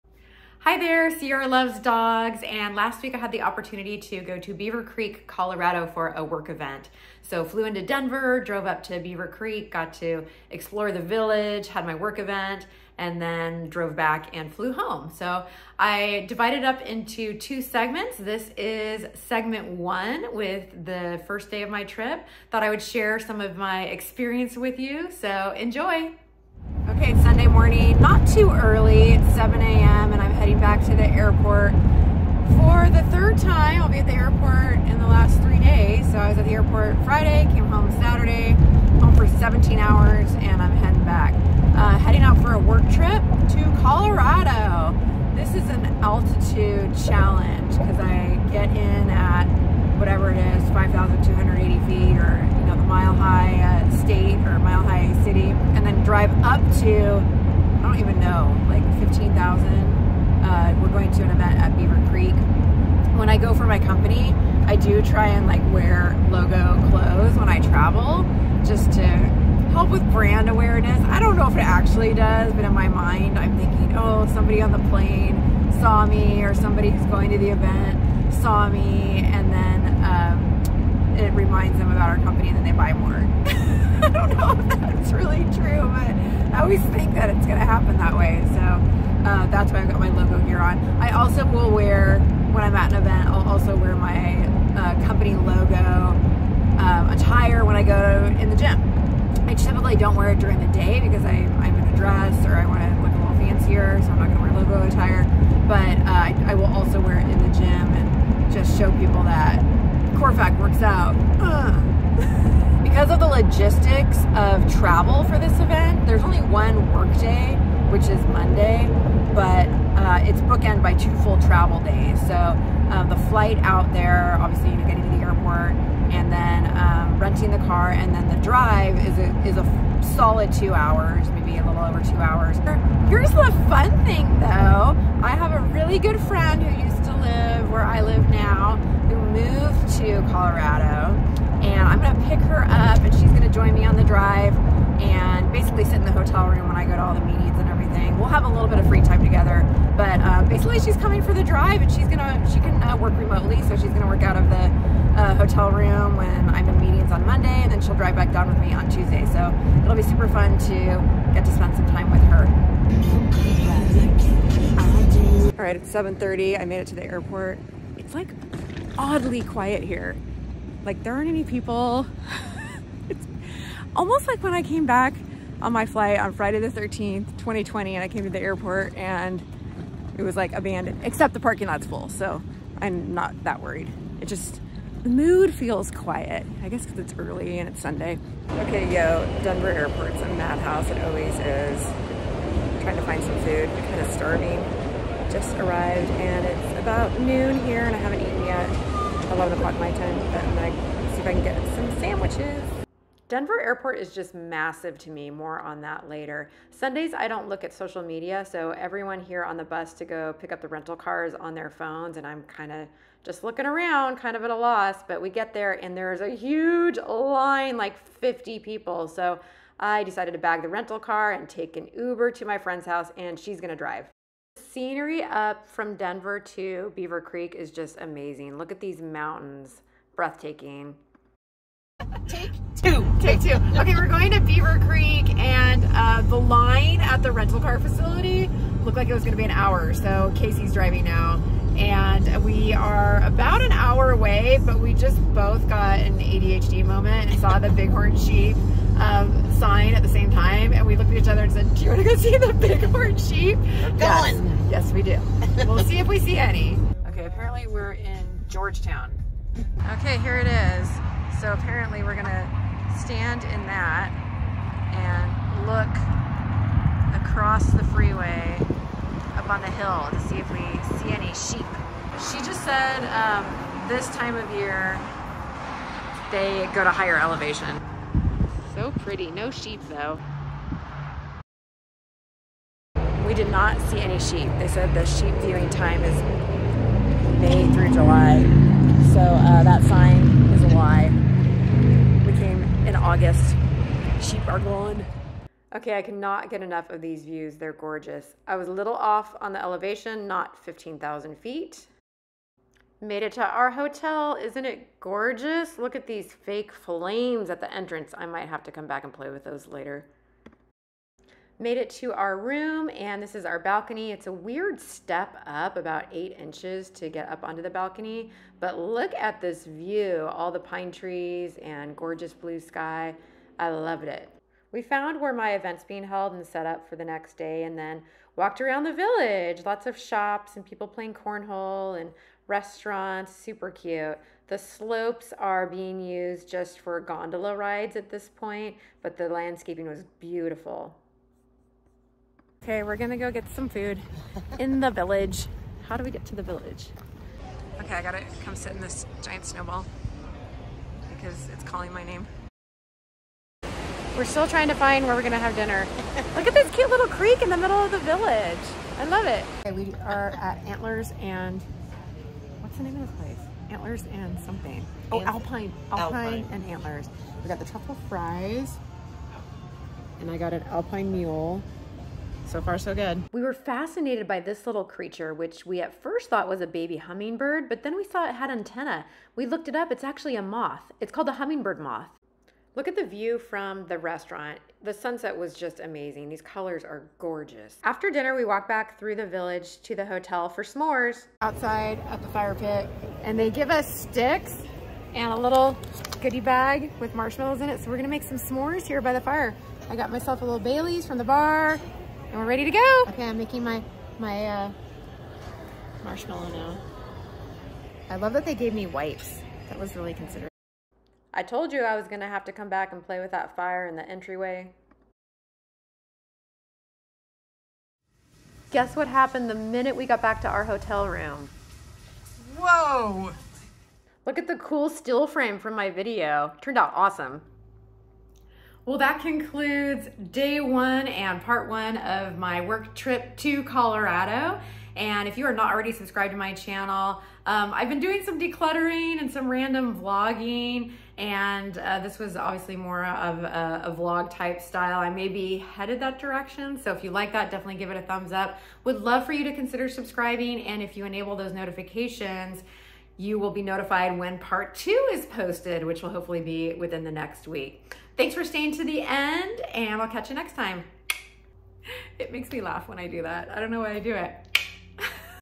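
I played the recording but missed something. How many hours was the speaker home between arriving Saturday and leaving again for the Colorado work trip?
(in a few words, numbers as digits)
17.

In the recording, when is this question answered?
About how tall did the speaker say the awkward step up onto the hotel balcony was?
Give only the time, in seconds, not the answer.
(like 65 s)
315 s.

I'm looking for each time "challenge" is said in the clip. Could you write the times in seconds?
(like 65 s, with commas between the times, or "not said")
47 s.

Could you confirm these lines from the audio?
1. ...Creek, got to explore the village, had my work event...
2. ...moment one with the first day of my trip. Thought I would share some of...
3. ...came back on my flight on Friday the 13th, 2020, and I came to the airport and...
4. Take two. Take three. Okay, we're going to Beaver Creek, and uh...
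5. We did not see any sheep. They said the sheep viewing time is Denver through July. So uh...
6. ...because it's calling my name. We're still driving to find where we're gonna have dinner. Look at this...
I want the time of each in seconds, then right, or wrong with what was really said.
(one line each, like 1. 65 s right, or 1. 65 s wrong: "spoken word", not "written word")
1. 9 s right
2. 19 s wrong: "segment", not "moment"
3. 174 s right
4. 232 s wrong: "two", not "three"
5. 283 s wrong: "May", not "Denver"
6. 351 s wrong: "trying", not "driving".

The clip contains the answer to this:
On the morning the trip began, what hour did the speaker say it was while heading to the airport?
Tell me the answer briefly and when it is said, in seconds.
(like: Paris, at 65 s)
7 a.m., at 29 s.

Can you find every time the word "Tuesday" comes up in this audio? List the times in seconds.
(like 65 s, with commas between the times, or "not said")
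158 s.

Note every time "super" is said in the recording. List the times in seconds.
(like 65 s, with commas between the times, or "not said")
160 s, 333 s.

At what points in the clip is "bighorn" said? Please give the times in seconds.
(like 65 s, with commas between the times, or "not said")
247 s, 252 s.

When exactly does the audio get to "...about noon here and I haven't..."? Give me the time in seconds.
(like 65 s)
196 s.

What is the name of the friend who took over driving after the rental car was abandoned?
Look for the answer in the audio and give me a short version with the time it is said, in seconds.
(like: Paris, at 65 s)
Casey, at 240 s.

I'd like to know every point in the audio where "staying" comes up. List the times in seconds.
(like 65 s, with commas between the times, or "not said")
458 s.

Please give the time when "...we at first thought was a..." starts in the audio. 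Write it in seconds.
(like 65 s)
375 s.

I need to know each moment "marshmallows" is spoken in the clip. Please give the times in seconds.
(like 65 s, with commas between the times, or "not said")
397 s, 406 s.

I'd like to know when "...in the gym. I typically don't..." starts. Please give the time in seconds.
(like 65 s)
98 s.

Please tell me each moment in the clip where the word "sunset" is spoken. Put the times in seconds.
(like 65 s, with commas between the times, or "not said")
384 s.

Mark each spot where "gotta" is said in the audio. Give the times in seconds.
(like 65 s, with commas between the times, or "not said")
348 s.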